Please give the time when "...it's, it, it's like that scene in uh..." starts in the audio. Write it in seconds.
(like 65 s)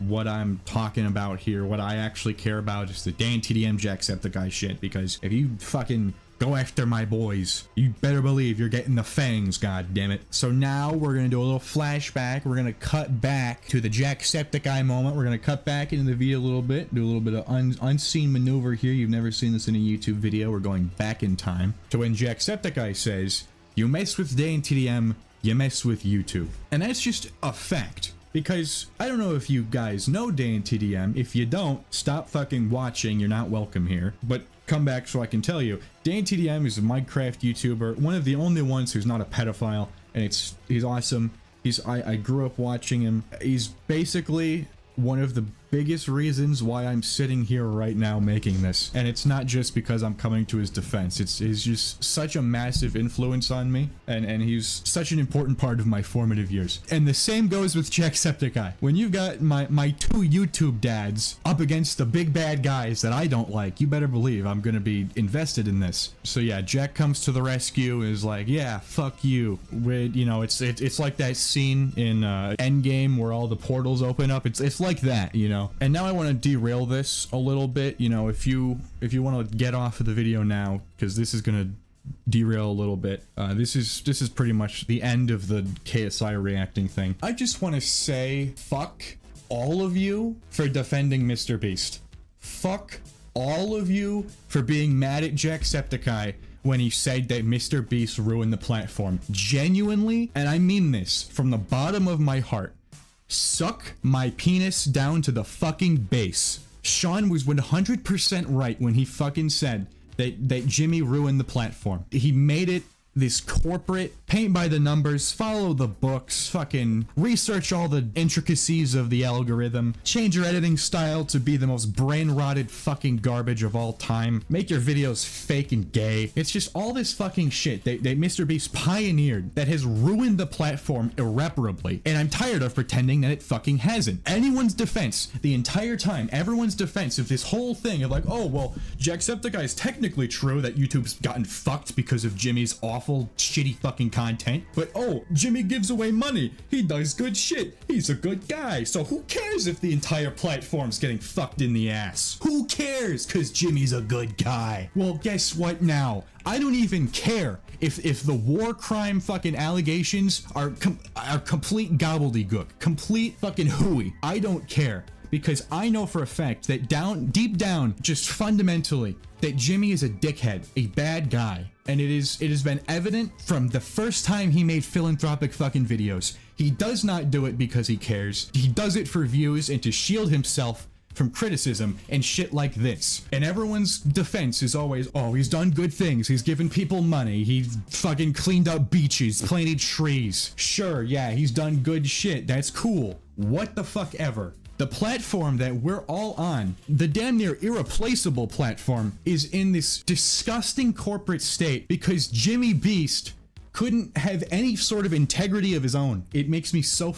70 s.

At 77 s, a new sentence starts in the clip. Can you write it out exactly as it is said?
You know, if you if you want to get off of the video now, because this is gonna derail a little bit.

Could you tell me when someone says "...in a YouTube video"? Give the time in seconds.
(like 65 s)
19 s.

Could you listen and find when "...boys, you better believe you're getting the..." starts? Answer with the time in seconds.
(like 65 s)
7 s.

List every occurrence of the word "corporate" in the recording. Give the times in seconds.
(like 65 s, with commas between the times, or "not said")
113 s, 200 s.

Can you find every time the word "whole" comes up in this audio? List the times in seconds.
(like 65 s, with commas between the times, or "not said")
137 s.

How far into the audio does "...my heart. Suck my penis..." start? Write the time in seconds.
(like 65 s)
102 s.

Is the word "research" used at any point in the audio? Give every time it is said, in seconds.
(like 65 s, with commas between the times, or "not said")
117 s.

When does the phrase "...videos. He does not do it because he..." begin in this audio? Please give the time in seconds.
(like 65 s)
175 s.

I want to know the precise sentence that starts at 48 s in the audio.
And it's not just because I'm coming to his defense.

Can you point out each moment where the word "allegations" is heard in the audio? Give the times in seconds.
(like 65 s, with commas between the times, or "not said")
159 s.